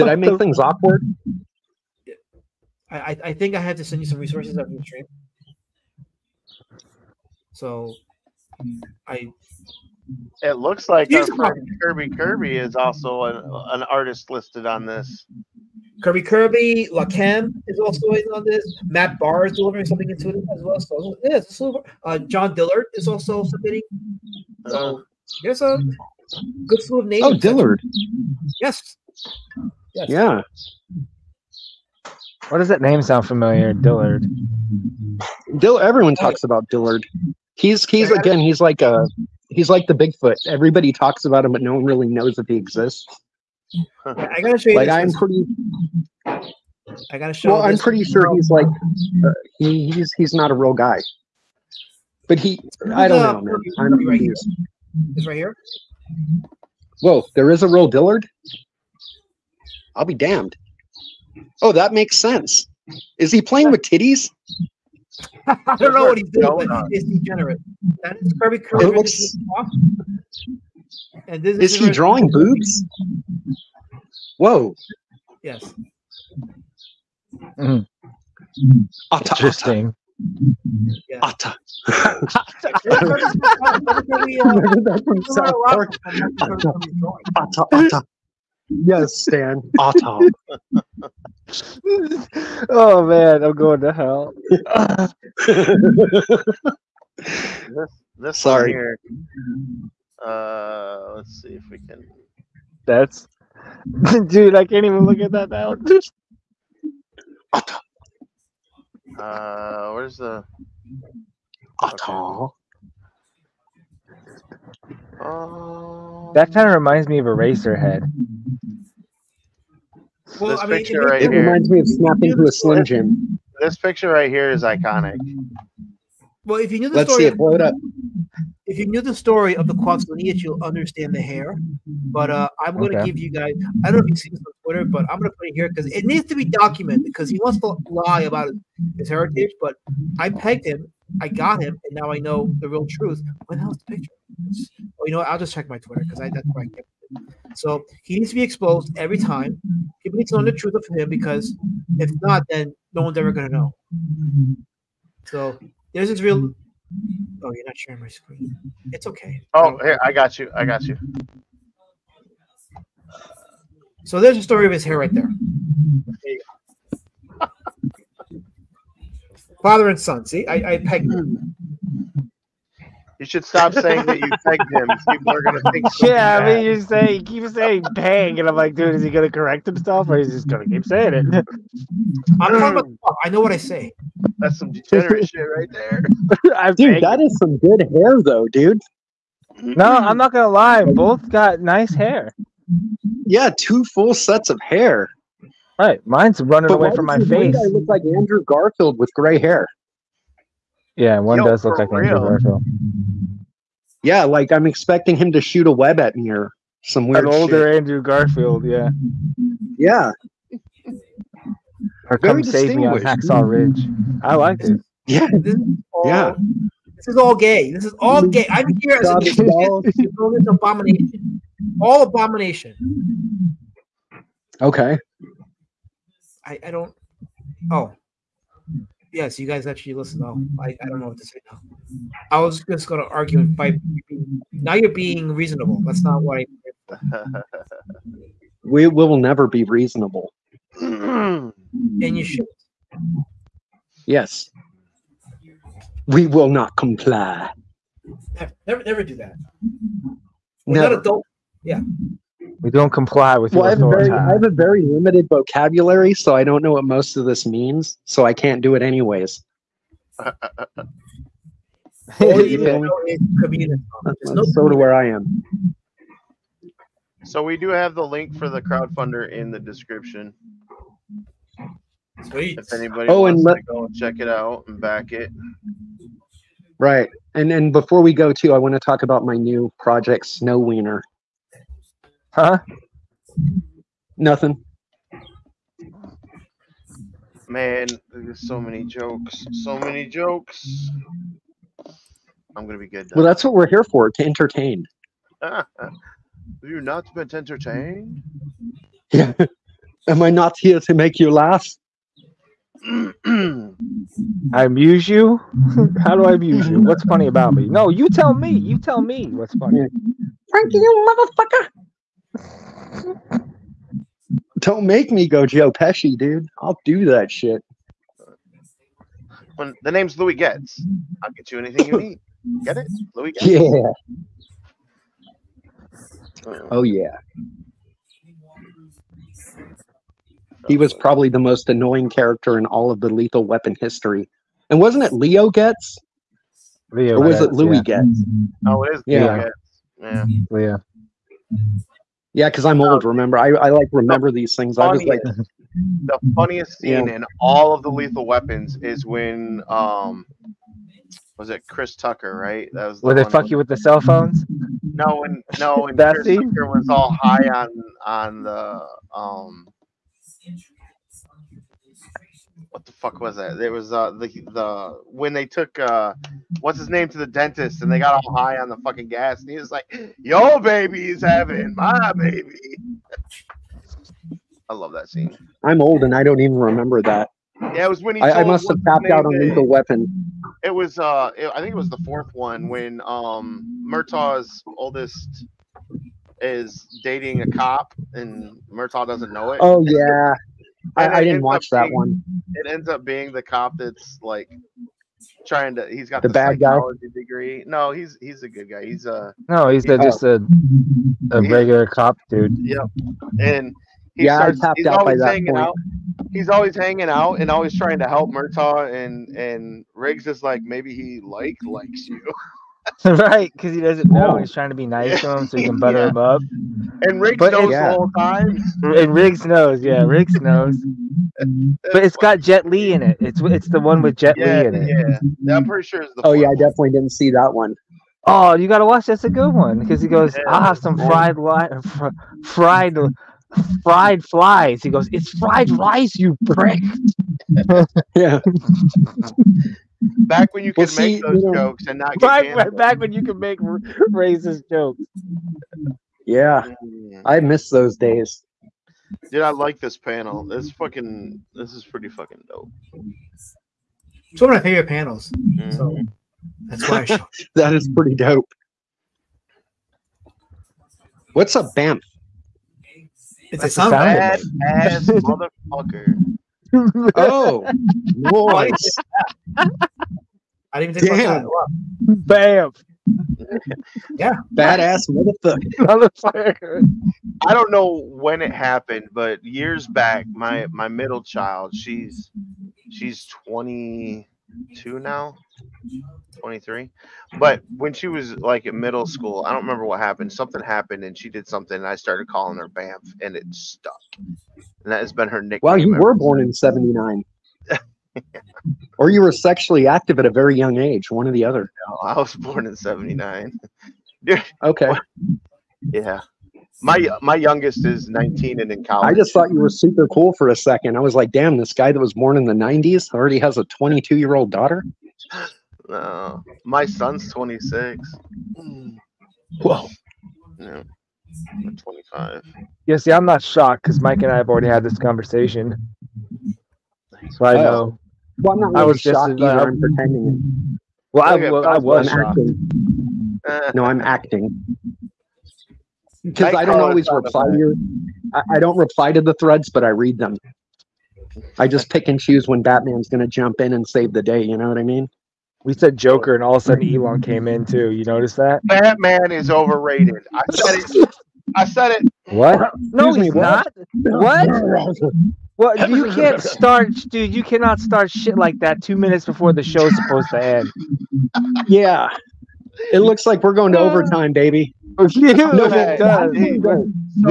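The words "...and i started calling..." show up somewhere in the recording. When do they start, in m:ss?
8:11.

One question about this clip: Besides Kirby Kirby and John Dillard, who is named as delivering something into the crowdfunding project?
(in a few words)
Matt Barr.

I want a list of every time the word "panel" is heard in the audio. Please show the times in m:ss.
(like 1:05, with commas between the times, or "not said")
7:29, 7:34.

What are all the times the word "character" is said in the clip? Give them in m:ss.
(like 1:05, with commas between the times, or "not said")
5:32.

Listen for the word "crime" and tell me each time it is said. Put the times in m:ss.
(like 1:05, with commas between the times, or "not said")
not said.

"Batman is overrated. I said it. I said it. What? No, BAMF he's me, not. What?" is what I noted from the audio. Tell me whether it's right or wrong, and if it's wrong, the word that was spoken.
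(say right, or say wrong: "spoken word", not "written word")
wrong: "Excuse", not "BAMF".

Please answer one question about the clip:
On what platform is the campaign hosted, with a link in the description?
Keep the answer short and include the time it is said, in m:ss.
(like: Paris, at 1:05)
Crowdfundr, at 4:28.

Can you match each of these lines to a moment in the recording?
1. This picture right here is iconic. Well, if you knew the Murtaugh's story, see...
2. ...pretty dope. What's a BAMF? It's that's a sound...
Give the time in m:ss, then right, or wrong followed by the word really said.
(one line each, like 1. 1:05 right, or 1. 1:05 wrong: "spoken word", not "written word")
1. 2:03 wrong: "Let", not "Murtaugh"
2. 7:37 right.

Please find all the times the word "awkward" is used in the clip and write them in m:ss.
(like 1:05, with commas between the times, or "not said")
0:00.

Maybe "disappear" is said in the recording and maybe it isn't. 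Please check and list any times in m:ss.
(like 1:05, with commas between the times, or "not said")
not said.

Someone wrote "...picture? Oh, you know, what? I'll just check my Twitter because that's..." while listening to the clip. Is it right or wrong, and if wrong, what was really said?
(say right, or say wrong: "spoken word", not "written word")
right.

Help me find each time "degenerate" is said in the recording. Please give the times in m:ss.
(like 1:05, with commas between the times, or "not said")
1:07, 3:04.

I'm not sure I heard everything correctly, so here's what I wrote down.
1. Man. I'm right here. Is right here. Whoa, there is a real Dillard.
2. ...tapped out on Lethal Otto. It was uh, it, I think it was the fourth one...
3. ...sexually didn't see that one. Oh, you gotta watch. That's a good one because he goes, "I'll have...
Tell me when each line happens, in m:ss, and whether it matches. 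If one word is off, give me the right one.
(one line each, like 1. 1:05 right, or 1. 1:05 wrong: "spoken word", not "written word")
1. 0:53 right
2. 6:18 wrong: "Weapon", not "Otto"
3. 7:06 wrong: "definitely", not "sexually".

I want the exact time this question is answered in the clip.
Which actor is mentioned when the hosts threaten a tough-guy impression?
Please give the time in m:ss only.
5:15.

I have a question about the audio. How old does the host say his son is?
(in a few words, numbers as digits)
26.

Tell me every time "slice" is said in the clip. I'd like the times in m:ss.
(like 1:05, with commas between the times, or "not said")
not said.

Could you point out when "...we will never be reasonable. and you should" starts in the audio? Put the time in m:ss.
3:58.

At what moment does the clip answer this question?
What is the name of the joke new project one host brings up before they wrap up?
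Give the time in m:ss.
4:40.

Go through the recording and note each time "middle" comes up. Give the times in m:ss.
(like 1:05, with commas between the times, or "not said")
8:00, 8:08.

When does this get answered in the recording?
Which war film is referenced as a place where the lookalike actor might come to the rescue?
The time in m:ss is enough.
3:32.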